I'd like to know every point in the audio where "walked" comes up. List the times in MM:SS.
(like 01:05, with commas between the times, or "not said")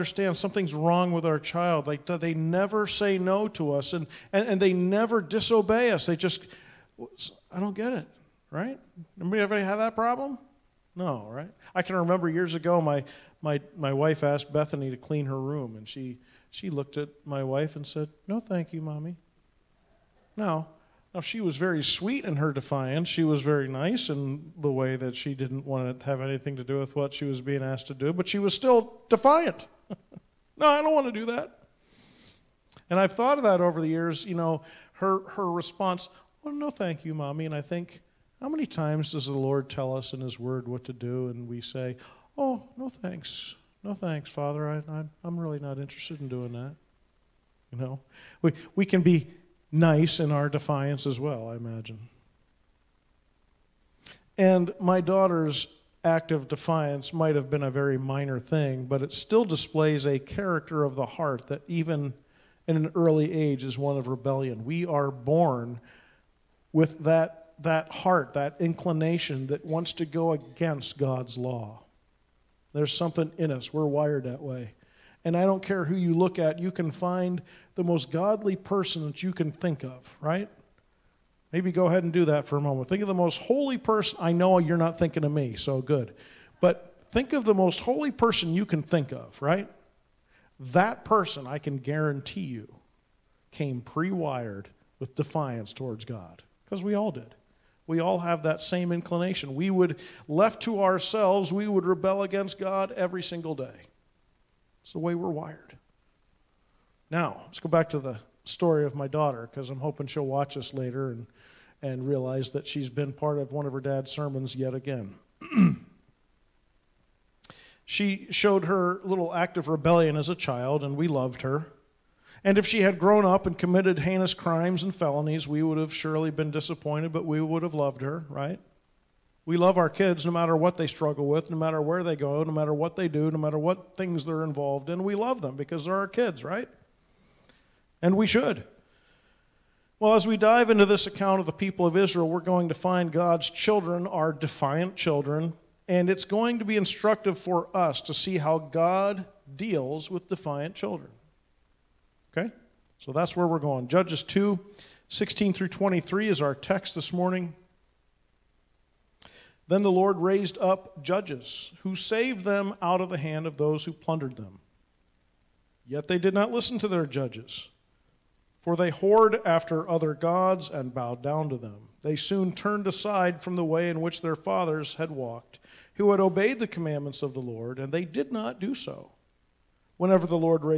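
02:55.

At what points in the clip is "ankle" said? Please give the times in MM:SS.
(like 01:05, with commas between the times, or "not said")
not said.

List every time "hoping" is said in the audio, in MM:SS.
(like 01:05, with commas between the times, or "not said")
01:49.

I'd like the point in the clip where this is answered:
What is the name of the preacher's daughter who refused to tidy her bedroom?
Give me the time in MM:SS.
00:14.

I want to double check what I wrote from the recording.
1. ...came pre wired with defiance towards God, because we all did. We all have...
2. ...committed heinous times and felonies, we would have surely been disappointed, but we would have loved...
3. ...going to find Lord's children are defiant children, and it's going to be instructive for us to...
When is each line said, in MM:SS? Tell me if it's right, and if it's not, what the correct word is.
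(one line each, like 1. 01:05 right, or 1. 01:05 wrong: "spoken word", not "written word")
1. 01:33 right
2. 02:03 wrong: "crimes", not "times"
3. 02:22 wrong: "God", not "Lord".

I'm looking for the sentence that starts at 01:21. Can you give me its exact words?
Maybe go ahead and do that for a moment.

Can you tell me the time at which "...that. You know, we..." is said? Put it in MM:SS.
00:46.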